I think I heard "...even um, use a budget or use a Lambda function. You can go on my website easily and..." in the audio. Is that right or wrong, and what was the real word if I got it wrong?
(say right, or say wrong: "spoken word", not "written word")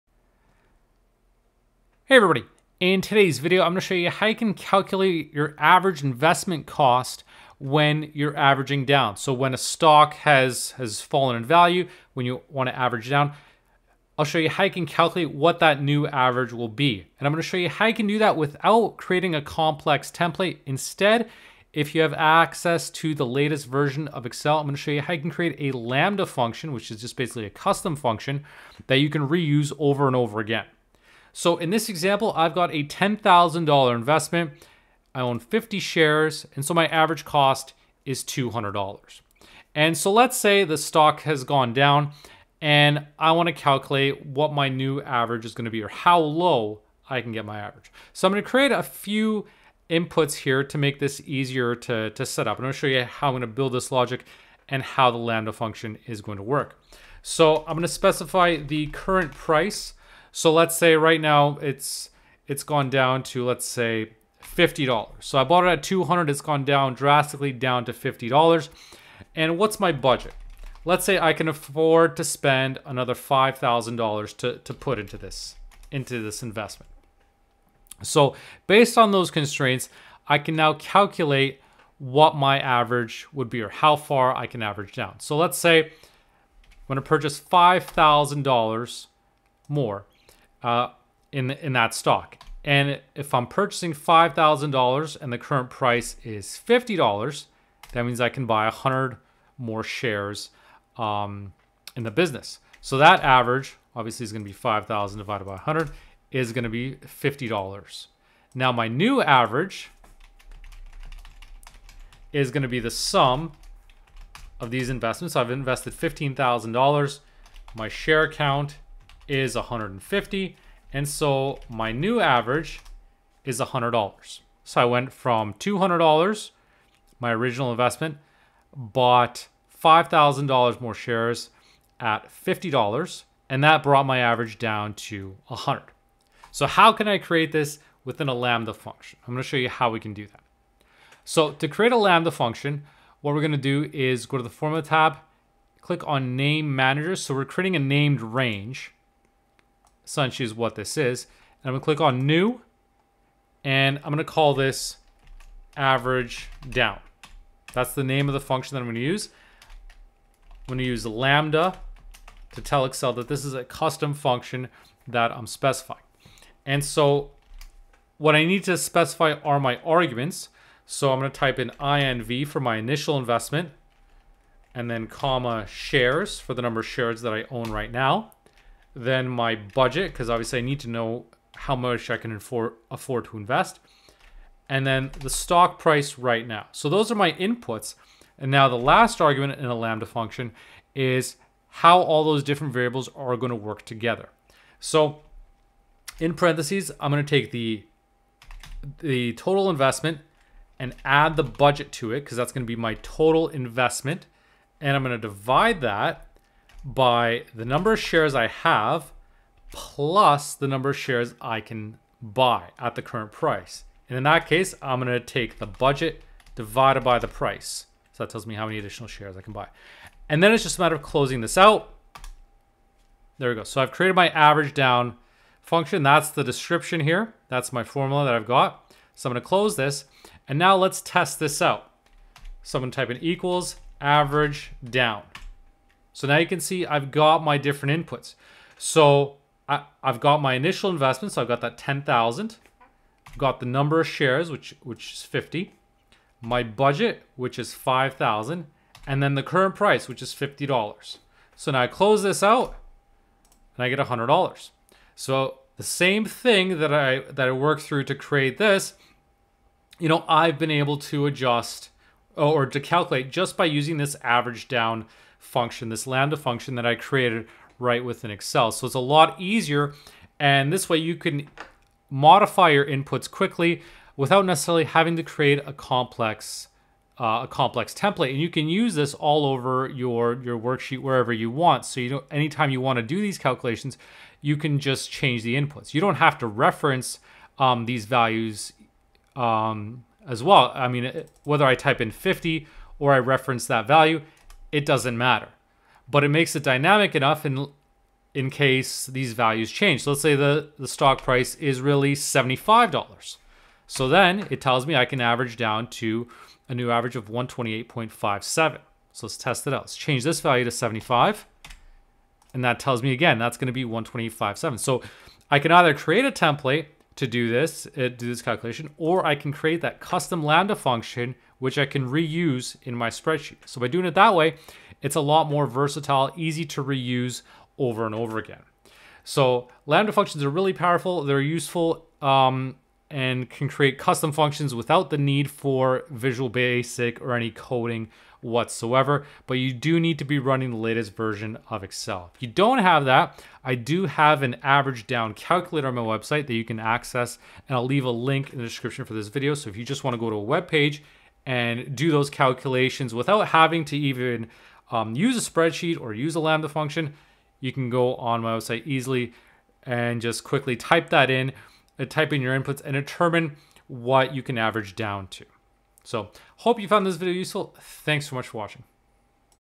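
wrong: "spreadsheet", not "budget".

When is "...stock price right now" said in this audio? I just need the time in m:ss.
3:05.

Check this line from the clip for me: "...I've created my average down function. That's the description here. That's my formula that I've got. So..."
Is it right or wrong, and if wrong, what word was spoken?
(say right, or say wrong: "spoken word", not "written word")
right.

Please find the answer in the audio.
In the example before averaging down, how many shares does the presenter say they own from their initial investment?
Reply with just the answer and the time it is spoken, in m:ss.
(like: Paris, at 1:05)
50, at 0:35.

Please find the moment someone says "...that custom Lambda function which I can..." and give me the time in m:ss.
5:19.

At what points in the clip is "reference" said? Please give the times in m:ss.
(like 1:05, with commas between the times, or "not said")
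4:46, 4:53.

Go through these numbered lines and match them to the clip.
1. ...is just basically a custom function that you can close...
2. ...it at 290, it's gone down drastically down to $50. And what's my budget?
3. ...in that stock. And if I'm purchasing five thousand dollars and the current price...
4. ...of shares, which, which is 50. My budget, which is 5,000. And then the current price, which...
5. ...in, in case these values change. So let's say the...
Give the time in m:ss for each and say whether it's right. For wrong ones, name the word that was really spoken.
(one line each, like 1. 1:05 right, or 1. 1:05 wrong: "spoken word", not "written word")
1. 0:26 wrong: "reuse", not "close"
2. 1:05 wrong: "200", not "290"
3. 1:31 right
4. 4:04 right
5. 4:57 right.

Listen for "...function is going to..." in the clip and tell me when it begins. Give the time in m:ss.
0:55.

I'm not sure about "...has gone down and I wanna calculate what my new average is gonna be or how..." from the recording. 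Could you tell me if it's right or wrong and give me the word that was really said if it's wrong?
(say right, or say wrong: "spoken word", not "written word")
right.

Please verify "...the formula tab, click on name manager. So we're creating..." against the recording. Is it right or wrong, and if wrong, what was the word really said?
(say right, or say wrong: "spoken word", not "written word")
right.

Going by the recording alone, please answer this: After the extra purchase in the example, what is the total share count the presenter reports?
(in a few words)
150.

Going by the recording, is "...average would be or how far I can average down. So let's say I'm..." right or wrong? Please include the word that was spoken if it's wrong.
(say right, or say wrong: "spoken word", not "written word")
right.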